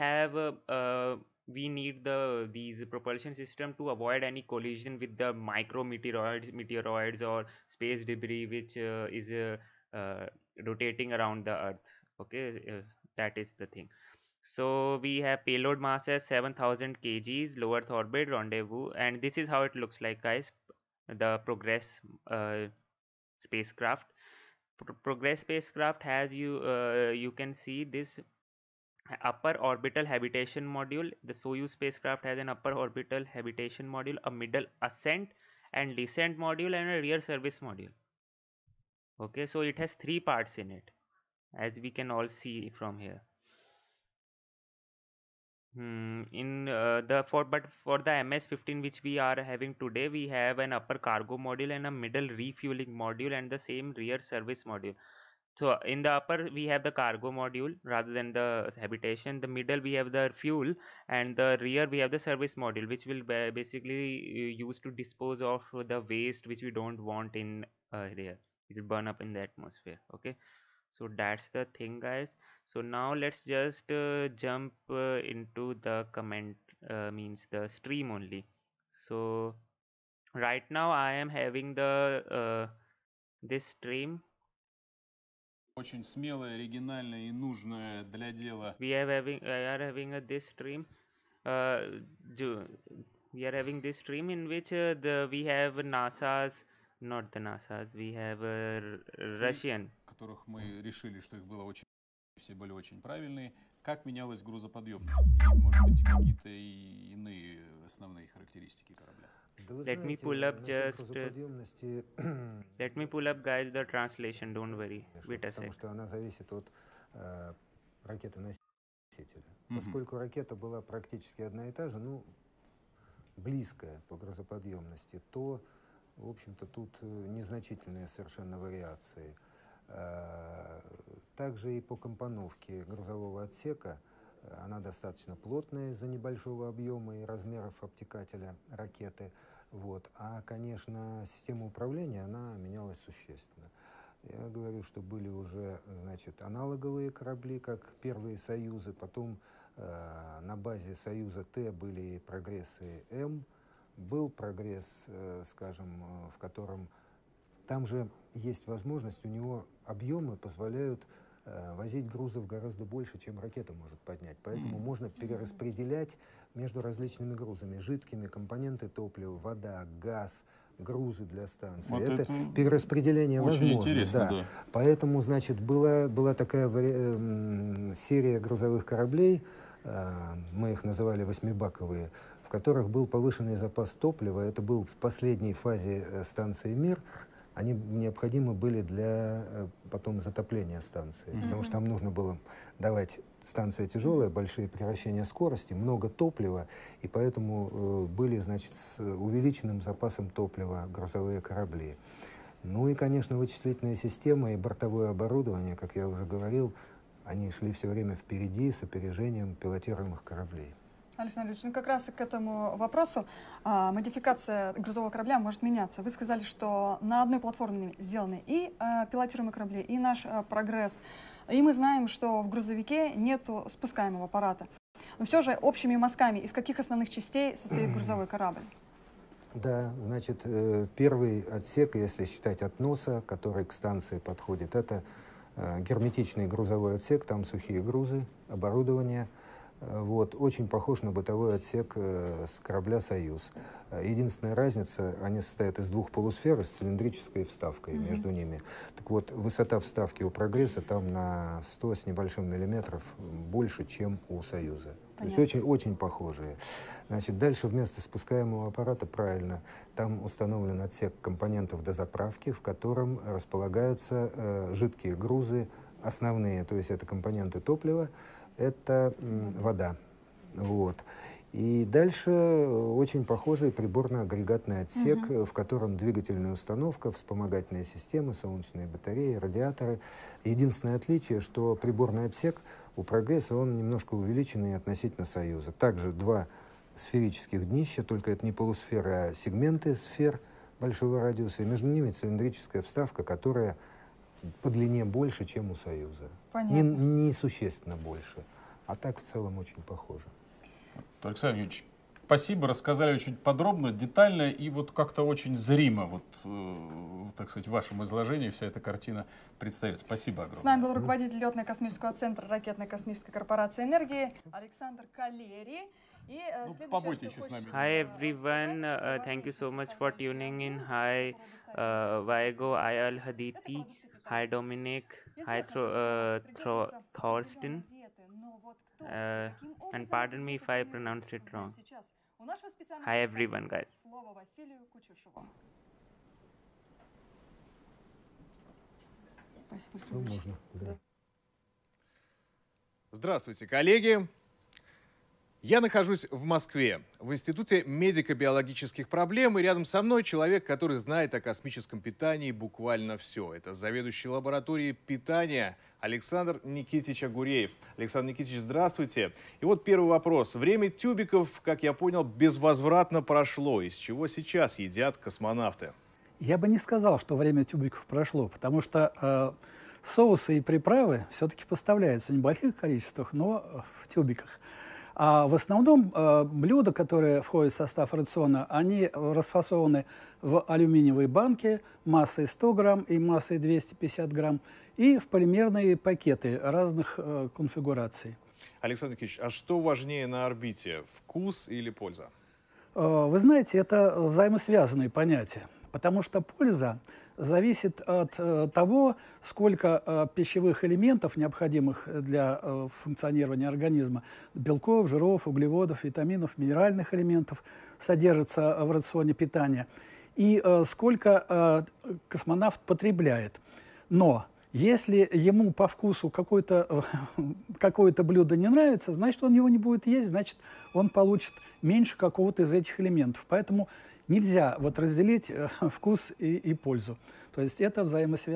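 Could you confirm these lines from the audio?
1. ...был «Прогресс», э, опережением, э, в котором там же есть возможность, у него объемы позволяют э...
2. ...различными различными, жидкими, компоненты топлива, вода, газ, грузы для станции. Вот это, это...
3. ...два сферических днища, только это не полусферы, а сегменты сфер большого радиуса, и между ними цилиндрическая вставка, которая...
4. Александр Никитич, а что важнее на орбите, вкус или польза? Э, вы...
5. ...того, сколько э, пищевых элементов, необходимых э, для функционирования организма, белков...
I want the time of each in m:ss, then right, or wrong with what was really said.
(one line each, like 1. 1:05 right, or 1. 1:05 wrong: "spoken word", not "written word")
1. 2:33 wrong: "скажем", not "опережением"
2. 2:46 wrong: "грузами", not "различными"
3. 4:46 right
4. 6:28 right
5. 6:38 right.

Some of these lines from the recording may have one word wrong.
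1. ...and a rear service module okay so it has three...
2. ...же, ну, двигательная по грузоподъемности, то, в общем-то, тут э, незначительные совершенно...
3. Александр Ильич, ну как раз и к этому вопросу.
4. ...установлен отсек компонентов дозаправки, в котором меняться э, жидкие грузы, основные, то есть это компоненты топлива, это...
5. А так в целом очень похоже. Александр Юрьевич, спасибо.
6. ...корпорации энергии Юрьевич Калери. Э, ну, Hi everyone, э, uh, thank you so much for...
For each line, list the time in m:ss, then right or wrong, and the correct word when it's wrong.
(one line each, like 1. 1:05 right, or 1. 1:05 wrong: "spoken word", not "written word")
1. 0:36 right
2. 2:01 wrong: "близкая", not "двигательная"
3. 3:31 right
4. 4:20 wrong: "располагаются", not "меняться"
5. 4:58 right
6. 5:13 wrong: "Александр", not "Юрьевич".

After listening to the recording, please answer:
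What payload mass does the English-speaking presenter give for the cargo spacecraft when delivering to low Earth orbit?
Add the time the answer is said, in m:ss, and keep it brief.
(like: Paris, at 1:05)
7000 kg, at 0:16.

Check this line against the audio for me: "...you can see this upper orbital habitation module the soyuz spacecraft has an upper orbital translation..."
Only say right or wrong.
wrong.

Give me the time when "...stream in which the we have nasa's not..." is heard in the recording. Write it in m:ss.
1:33.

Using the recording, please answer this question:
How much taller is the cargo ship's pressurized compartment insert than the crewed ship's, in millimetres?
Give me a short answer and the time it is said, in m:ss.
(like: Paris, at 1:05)
just over 100 mm, at 4:11.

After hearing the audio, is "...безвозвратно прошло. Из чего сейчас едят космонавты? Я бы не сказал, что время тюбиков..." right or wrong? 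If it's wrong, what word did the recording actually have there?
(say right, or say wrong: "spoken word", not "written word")
right.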